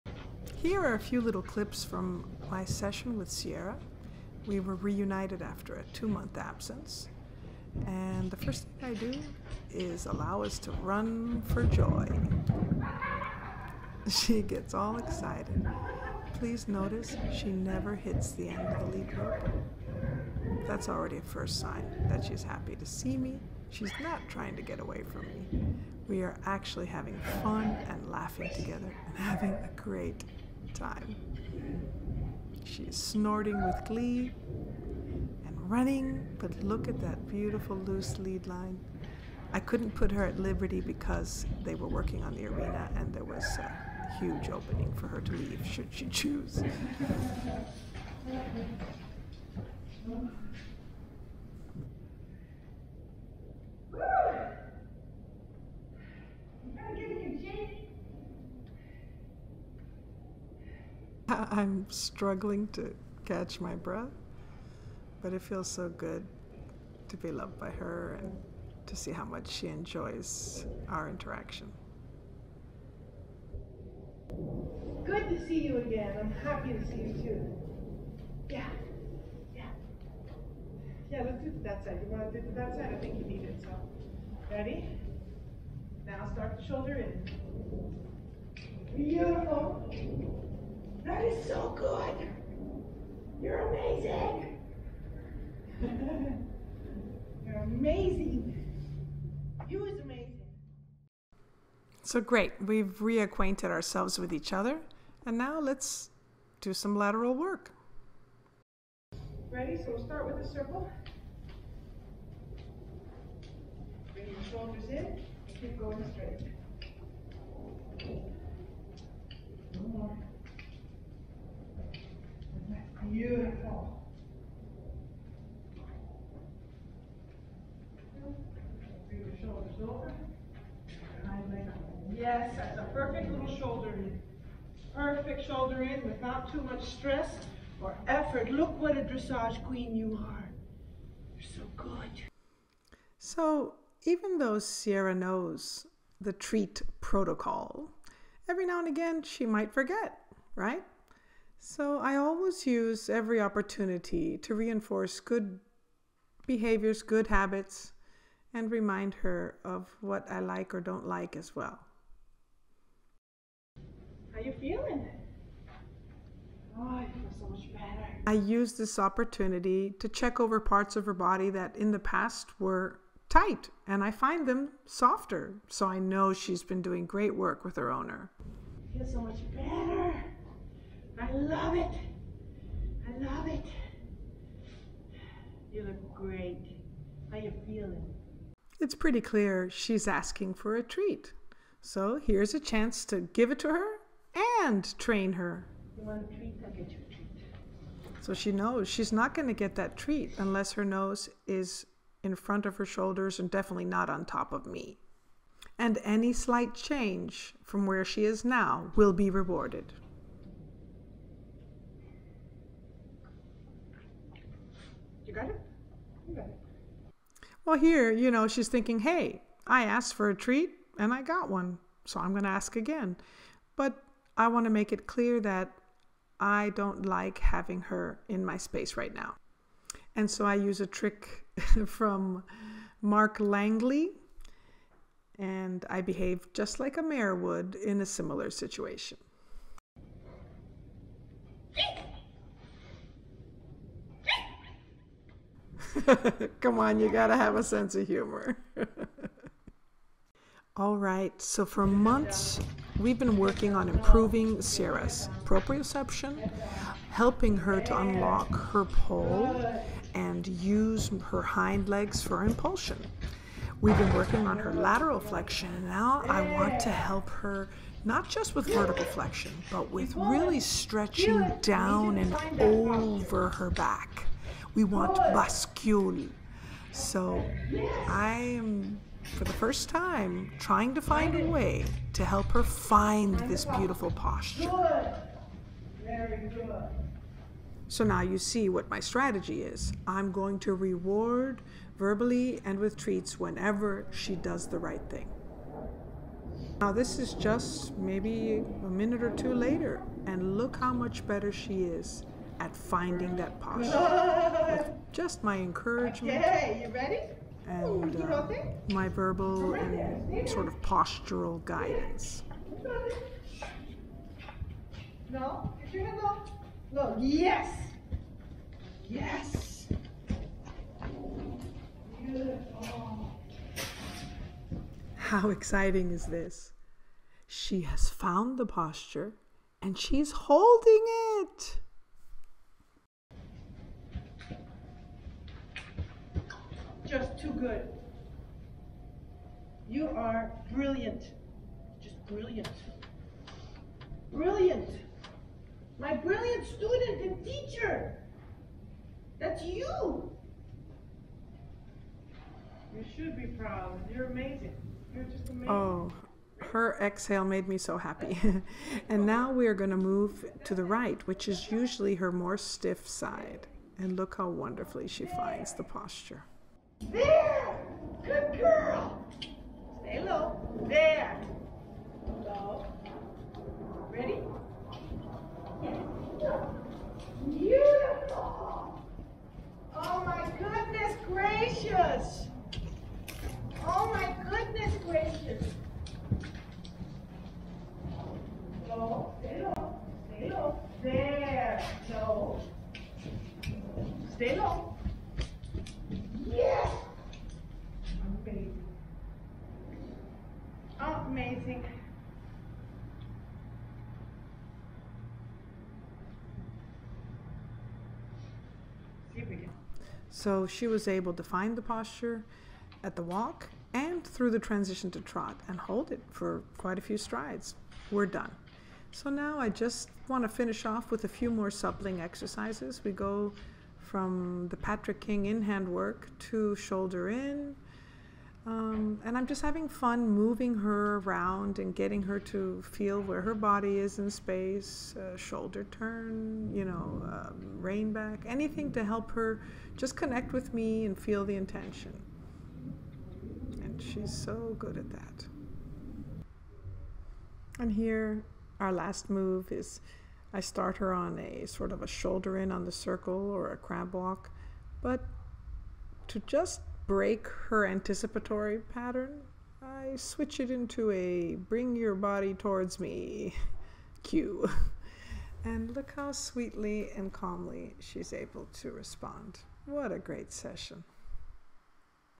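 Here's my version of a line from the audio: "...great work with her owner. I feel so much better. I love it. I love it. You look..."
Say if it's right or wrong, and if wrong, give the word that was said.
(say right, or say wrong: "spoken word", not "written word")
right.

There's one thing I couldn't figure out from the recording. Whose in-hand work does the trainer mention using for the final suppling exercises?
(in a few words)
Patrick King.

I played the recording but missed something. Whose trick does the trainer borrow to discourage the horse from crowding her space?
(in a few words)
Mark Langley.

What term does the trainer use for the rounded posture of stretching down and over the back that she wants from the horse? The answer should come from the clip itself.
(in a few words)
Bascule.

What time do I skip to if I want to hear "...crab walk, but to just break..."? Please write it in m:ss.
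7:33.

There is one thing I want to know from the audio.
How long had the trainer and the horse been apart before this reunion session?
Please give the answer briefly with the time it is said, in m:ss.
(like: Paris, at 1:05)
2 months, at 0:05.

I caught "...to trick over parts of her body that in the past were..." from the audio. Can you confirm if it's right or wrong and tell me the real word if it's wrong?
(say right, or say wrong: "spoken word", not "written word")
wrong: "check", not "trick".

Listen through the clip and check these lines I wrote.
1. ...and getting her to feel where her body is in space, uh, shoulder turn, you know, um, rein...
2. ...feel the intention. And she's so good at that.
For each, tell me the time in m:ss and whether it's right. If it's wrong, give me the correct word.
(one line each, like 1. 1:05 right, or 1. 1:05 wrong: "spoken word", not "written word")
1. 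7:11 right
2. 7:21 right.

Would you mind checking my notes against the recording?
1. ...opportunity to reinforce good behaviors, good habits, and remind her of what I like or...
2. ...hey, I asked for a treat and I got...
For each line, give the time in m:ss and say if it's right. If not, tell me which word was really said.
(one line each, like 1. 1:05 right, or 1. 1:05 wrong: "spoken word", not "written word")
1. 2:33 right
2. 3:38 right.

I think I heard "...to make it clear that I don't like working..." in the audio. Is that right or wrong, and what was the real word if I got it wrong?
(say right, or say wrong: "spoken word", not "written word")
wrong: "having", not "working".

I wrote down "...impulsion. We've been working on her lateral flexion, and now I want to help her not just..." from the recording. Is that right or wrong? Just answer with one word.
right.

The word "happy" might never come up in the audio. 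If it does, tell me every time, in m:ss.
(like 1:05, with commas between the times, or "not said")
0:22, 1:16, 5:57.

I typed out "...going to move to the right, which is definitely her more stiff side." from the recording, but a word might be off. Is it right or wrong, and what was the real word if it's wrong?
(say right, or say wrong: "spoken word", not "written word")
wrong: "usually", not "definitely".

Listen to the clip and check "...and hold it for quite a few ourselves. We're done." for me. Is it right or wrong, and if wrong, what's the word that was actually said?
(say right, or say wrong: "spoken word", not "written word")
wrong: "strides", not "ourselves".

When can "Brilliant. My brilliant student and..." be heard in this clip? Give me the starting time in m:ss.
5:44.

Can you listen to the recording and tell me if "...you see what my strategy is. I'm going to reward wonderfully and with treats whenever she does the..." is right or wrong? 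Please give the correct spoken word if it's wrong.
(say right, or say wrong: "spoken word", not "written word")
wrong: "verbally", not "wonderfully".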